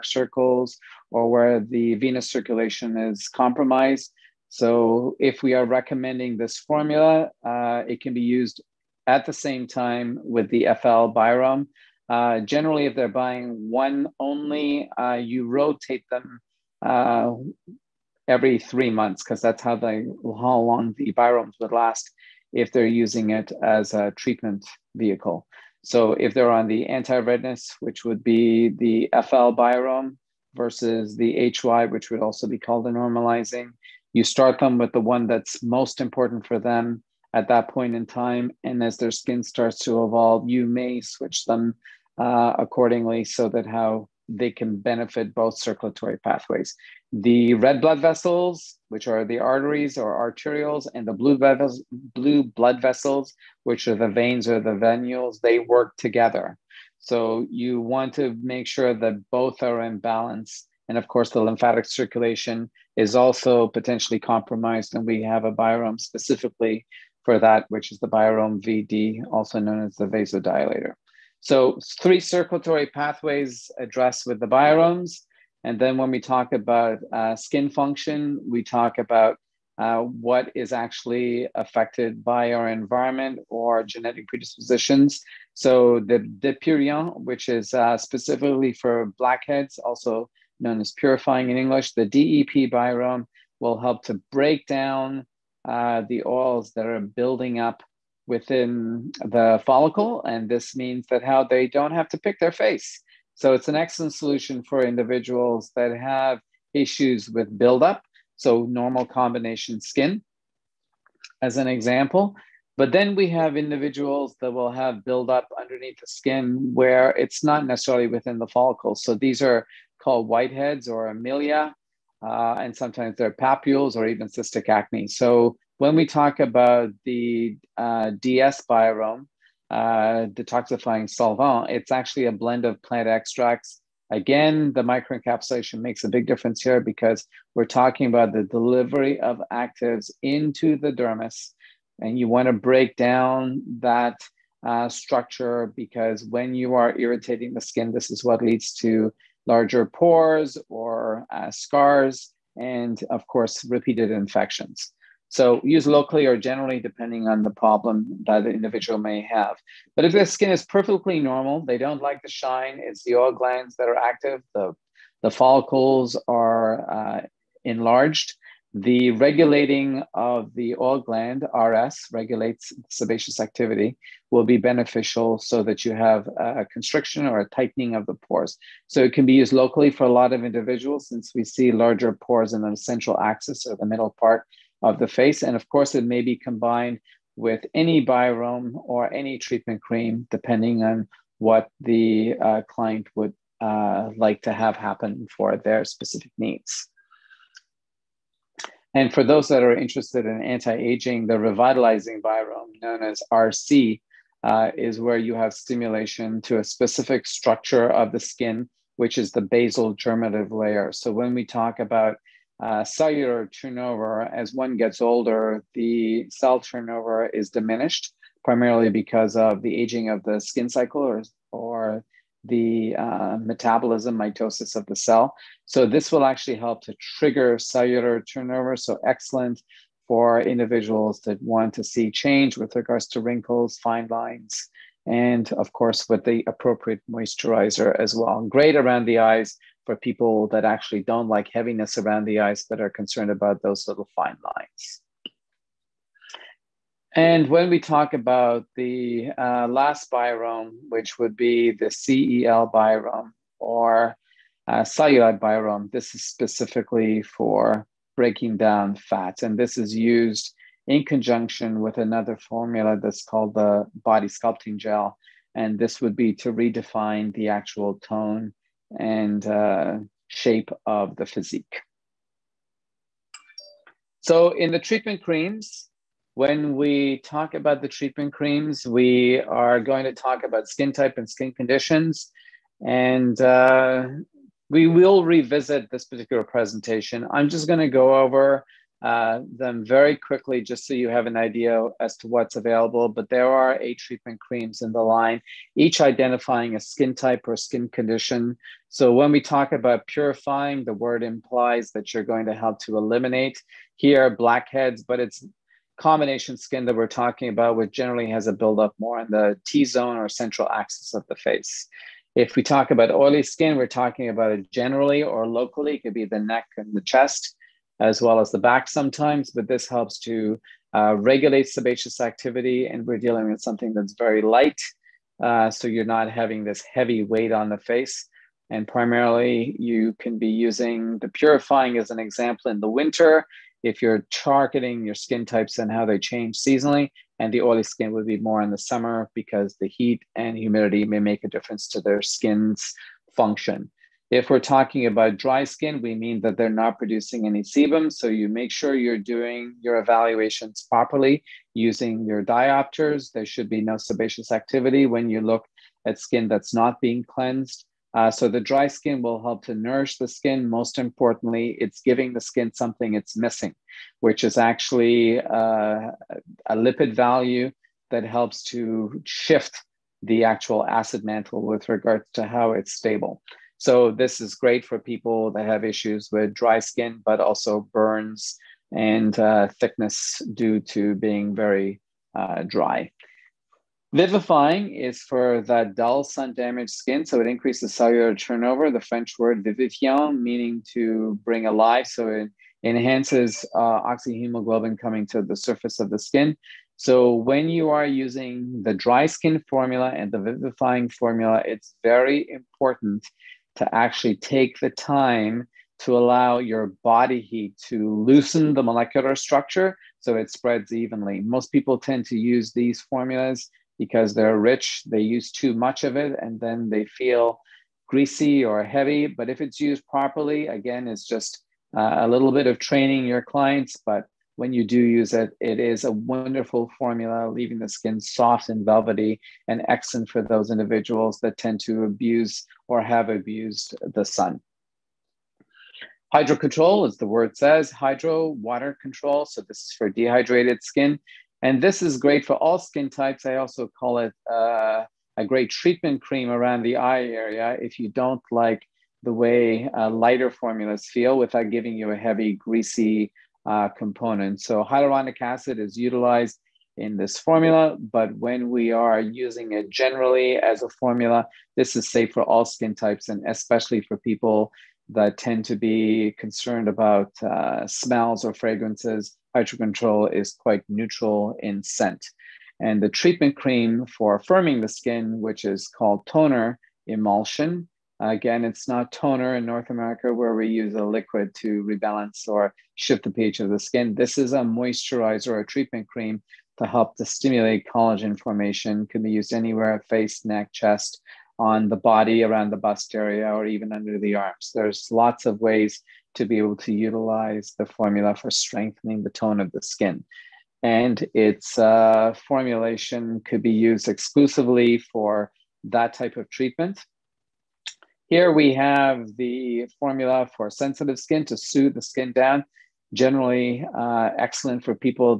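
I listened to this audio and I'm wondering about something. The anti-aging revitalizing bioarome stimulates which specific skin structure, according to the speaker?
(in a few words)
basal germinative layer.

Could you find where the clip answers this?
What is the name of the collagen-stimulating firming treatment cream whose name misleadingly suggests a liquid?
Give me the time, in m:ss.
7:56.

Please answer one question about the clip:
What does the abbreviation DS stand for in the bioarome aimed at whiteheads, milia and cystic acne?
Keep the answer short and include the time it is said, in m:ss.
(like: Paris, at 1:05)
detoxifying solvent, at 2:10.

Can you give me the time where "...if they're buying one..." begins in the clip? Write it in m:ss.
0:12.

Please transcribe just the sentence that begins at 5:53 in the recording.
There should be no sebaceous activity when you look at skin that's not being cleansed.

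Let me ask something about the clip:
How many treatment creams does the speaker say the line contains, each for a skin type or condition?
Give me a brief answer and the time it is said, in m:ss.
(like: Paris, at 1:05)
8, at 4:53.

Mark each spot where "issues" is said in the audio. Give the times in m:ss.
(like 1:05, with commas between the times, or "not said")
1:46, 6:15.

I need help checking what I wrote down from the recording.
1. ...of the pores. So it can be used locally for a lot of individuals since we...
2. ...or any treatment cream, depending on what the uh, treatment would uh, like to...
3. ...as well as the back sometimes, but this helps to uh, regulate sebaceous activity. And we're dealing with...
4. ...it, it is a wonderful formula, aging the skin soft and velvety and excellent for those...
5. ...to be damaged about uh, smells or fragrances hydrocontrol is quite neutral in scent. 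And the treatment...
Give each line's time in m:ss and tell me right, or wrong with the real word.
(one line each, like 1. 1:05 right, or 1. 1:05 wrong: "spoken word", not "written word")
1. 2:57 right
2. 3:08 wrong: "client", not "treatment"
3. 5:17 right
4. 7:05 wrong: "leaving", not "aging"
5. 7:45 wrong: "concerned", not "damaged".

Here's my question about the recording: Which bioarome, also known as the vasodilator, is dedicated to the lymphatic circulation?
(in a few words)
VD.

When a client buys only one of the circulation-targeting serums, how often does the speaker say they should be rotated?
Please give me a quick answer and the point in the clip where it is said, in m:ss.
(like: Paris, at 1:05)
every 3 months, at 0:18.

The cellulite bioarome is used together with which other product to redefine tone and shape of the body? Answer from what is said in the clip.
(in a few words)
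body sculpting gel.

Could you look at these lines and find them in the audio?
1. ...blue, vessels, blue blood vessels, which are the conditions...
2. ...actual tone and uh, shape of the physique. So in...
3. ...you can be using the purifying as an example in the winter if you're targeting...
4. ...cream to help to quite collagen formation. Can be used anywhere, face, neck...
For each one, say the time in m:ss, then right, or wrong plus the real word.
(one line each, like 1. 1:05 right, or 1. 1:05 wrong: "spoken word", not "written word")
1. 0:51 wrong: "veins", not "conditions"
2. 4:27 right
3. 5:29 right
4. 8:06 wrong: "stimulate", not "quite".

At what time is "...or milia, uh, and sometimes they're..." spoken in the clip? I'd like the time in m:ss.
2:00.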